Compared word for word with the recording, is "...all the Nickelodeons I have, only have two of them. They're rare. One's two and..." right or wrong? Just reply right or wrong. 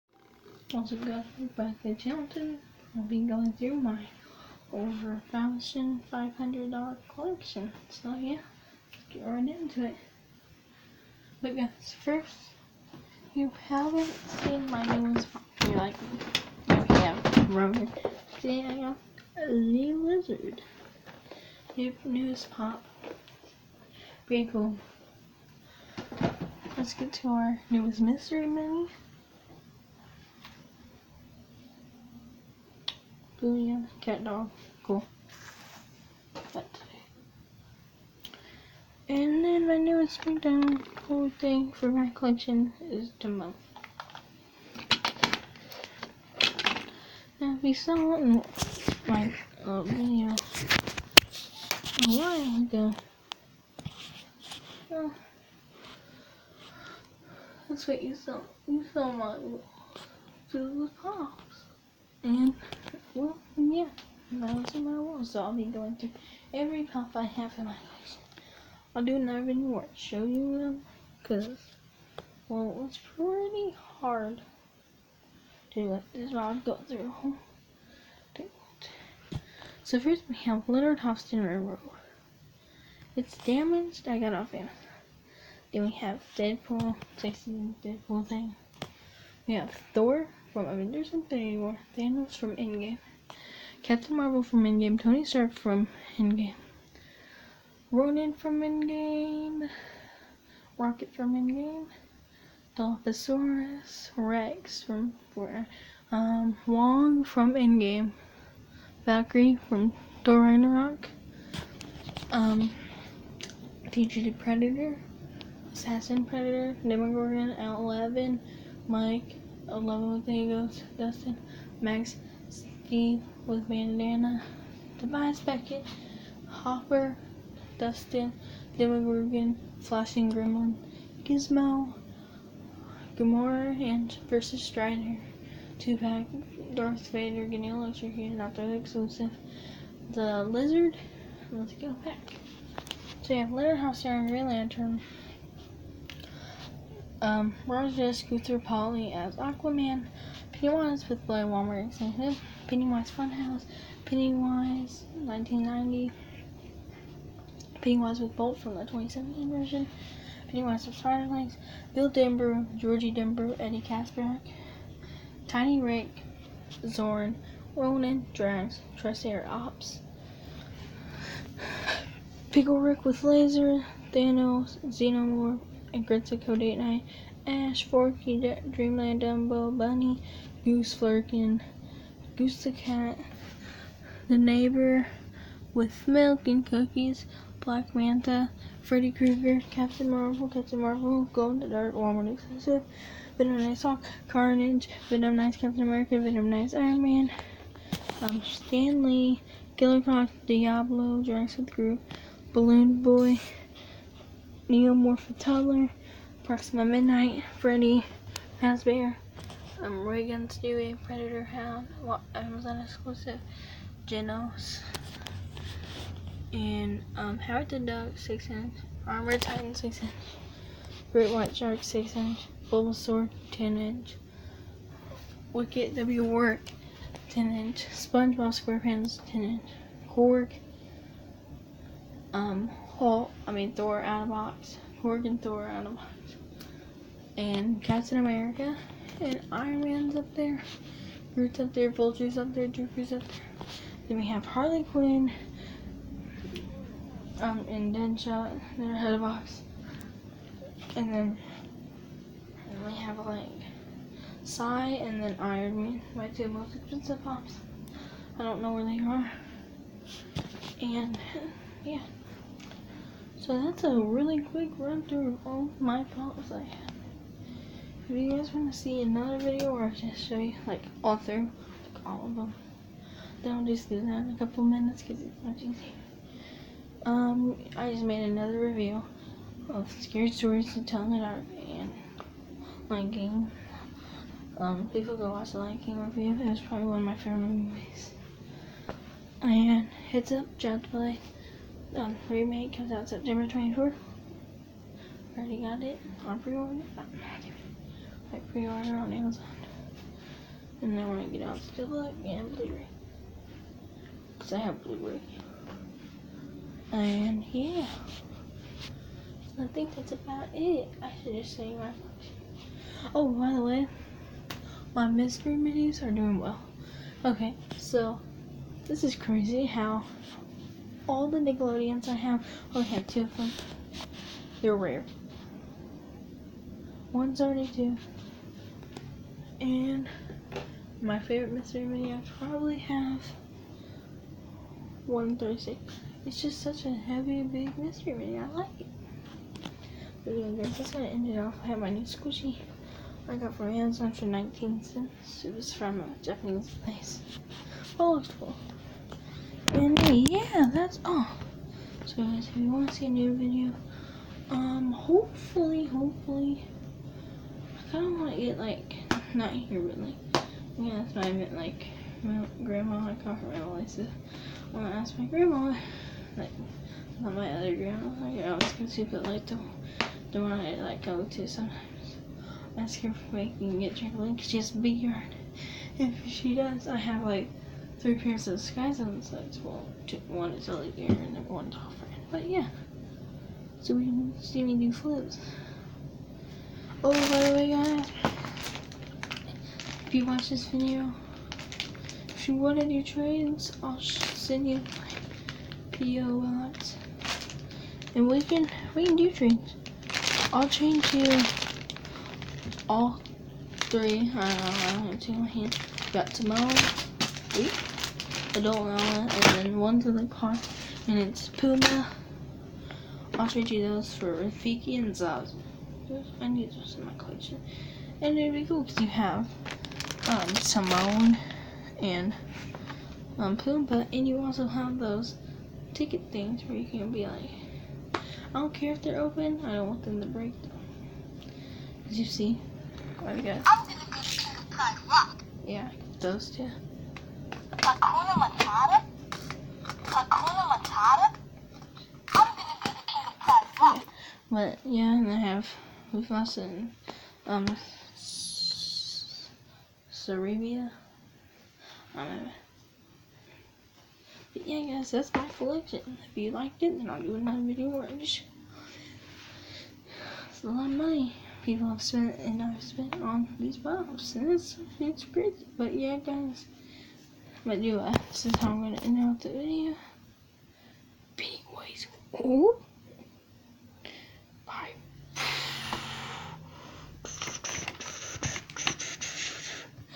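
right.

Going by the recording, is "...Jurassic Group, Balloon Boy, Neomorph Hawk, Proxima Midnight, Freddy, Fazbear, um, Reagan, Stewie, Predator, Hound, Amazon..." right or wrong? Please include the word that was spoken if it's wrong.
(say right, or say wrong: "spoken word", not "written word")
wrong: "Toddler", not "Hawk".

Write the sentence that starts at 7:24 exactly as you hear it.
But yeah, and I have Mufasa and um Cerebia.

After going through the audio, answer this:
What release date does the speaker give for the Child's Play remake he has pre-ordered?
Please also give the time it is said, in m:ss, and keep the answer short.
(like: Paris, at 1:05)
September 24th, at 4:53.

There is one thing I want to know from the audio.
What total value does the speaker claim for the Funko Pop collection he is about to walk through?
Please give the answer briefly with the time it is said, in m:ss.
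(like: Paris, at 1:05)
Over $1,500, at 0:04.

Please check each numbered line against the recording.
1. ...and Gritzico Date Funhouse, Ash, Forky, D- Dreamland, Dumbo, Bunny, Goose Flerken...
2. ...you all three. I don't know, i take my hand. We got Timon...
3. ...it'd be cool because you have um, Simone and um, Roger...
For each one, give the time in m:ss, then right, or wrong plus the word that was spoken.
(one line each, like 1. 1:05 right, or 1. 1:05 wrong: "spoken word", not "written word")
1. 2:55 wrong: "Night", not "Funhouse"
2. 6:41 right
3. 6:58 wrong: "Pumbaa", not "Roger".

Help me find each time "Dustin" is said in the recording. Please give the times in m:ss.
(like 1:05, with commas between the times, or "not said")
2:00, 2:07.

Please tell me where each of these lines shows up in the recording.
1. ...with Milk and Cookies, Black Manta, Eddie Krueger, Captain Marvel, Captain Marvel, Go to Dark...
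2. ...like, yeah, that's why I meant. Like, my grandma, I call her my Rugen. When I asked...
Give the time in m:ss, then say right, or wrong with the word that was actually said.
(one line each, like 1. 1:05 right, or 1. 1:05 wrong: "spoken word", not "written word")
1. 3:05 wrong: "Freddy", not "Eddie"
2. 5:59 wrong: "Melissa", not "Rugen".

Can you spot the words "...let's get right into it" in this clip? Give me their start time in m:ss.
0:08.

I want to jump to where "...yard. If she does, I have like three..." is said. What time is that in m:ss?
6:14.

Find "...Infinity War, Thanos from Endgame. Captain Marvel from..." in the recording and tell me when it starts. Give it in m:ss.
1:31.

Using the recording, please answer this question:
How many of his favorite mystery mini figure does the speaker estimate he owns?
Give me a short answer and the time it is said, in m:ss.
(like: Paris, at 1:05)
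136, at 5:35.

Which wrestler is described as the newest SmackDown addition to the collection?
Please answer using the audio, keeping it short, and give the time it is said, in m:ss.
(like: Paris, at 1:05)
Demo, at 0:43.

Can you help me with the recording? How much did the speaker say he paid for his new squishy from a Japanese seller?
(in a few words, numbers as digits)
19 cents.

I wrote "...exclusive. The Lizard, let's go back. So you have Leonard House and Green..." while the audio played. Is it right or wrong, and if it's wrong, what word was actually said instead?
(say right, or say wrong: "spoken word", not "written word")
right.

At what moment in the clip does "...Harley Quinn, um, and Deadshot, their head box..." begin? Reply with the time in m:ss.
4:04.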